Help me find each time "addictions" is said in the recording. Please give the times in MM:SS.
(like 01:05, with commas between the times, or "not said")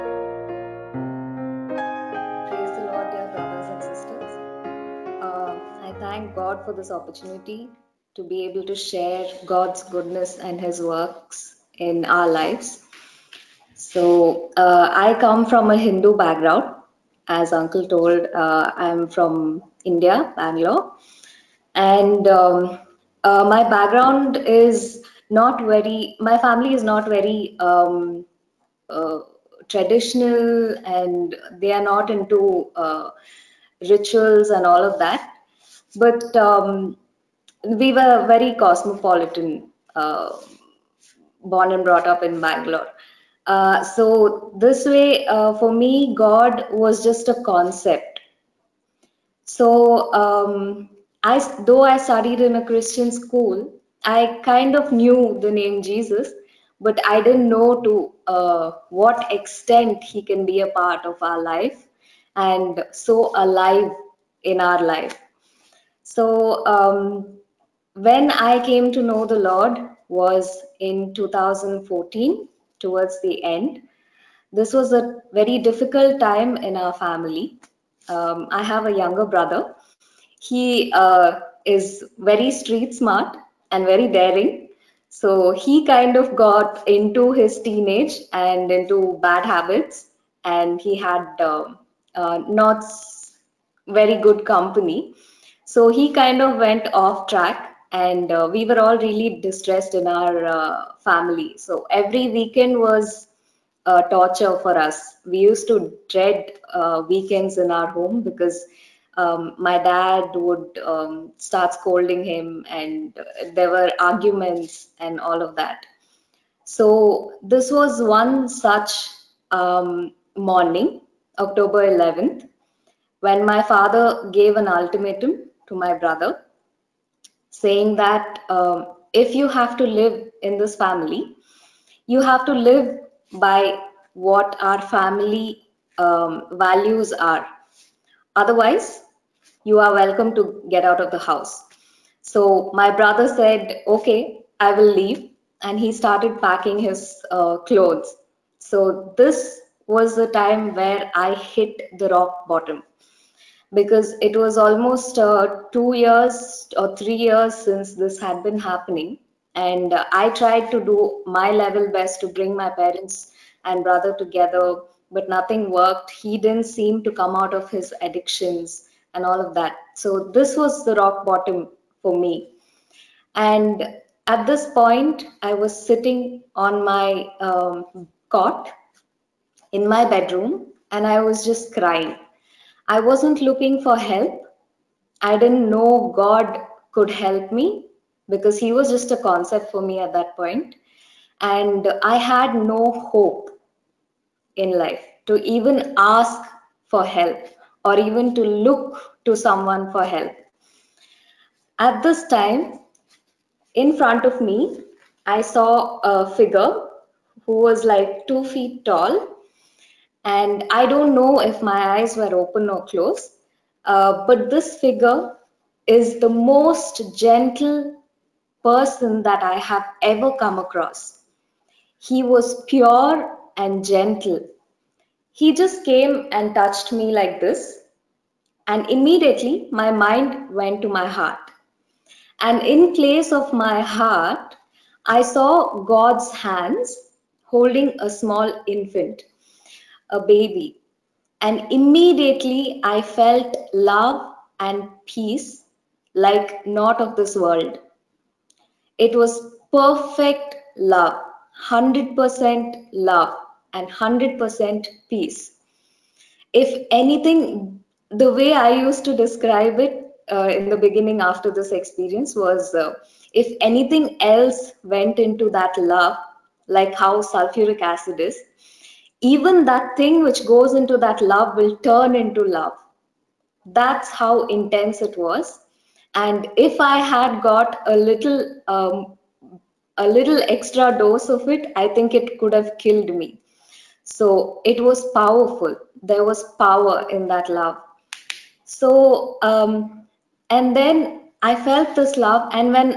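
02:48.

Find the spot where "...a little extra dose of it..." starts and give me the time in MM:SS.
04:39.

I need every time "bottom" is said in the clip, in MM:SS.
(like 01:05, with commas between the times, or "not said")
02:32, 02:51.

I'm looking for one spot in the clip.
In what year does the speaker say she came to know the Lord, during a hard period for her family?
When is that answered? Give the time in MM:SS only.
01:11.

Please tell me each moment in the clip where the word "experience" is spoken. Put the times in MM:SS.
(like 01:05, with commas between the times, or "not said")
04:21.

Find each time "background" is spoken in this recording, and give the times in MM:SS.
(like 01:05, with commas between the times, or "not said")
00:16, 00:23.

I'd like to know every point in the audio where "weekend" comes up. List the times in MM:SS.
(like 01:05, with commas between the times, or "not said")
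01:42, 01:47.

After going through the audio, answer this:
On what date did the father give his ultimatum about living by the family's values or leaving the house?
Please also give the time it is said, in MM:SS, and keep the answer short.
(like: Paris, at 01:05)
October 11th, at 02:01.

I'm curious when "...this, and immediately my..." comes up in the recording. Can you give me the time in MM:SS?
03:47.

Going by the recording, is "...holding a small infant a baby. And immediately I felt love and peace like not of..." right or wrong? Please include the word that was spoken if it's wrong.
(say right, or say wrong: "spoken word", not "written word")
right.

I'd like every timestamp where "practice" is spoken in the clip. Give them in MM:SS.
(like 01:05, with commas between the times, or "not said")
not said.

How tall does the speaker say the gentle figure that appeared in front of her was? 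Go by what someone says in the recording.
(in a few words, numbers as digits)
2 feet.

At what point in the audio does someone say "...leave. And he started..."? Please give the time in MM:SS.
02:24.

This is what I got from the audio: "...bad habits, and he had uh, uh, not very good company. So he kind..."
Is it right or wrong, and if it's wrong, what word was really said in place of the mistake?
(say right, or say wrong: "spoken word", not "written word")
right.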